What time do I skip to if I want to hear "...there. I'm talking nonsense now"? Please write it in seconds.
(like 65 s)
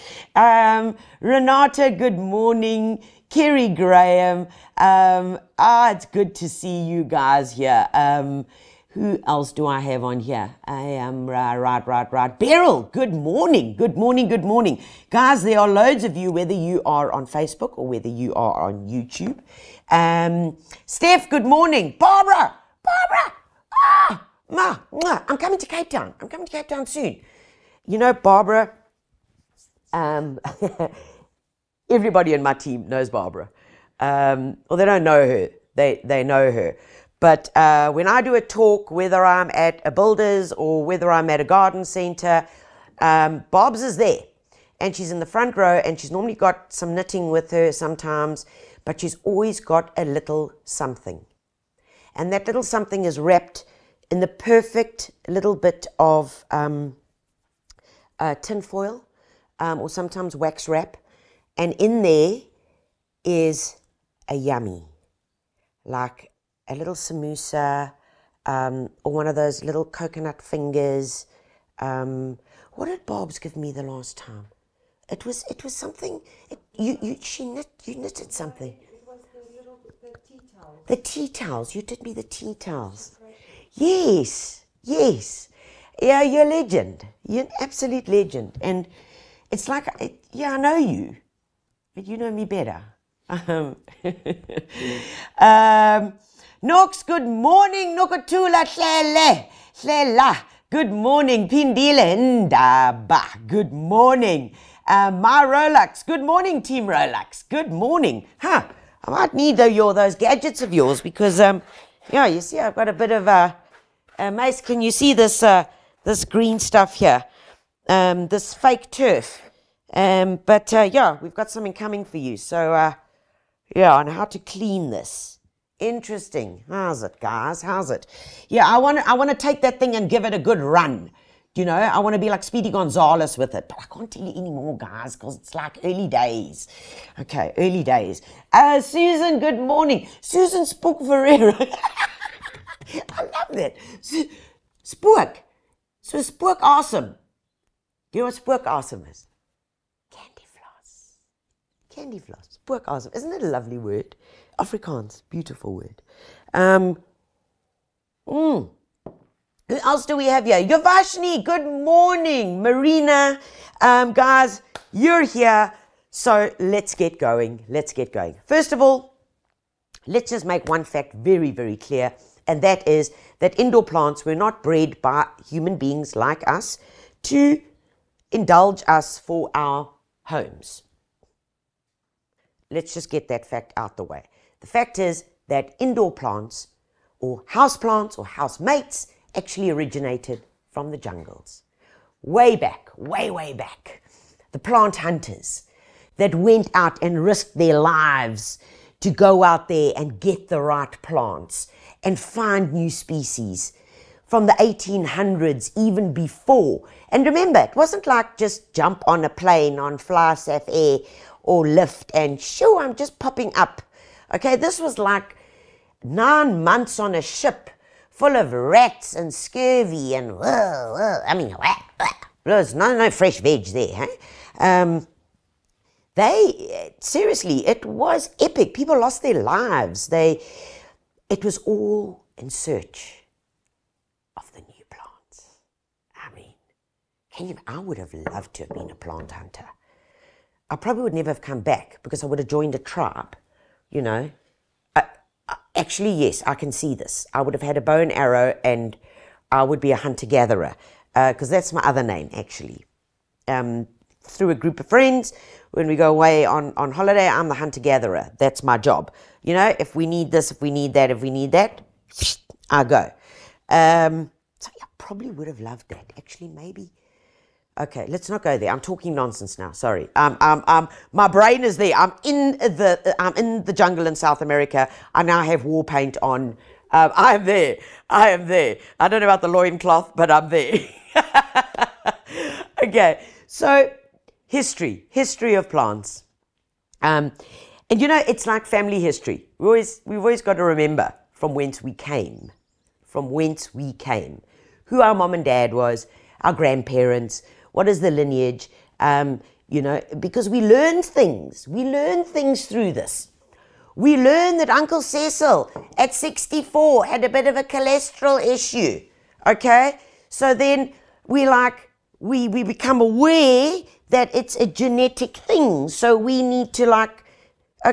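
268 s.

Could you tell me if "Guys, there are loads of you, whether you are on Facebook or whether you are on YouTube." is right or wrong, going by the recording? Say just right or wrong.
right.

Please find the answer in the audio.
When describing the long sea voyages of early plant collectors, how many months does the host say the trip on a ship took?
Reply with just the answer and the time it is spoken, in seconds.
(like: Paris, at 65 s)
9, at 216 s.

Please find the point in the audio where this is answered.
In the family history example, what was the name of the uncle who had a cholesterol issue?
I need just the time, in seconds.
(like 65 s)
304 s.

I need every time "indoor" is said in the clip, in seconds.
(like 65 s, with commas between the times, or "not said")
173 s, 185 s.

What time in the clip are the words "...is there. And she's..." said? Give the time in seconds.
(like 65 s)
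43 s.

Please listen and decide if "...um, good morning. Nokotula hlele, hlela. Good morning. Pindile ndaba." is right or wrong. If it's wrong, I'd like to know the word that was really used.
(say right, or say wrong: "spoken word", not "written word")
right.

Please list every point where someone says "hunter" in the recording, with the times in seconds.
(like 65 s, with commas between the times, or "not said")
194 s, 239 s, 249 s, 257 s.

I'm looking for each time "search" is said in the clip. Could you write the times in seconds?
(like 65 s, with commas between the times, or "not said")
232 s.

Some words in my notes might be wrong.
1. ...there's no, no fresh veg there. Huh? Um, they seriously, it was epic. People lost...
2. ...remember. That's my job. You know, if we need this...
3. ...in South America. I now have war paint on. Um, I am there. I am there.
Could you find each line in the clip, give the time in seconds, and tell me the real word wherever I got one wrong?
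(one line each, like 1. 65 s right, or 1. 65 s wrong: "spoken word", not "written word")
1. 222 s right
2. 257 s wrong: "gatherer", not "remember"
3. 274 s right.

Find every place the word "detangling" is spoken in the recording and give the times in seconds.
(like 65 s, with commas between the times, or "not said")
not said.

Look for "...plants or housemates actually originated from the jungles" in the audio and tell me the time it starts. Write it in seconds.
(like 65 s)
187 s.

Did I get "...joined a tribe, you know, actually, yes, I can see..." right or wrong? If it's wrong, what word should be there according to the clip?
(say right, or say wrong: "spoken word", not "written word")
right.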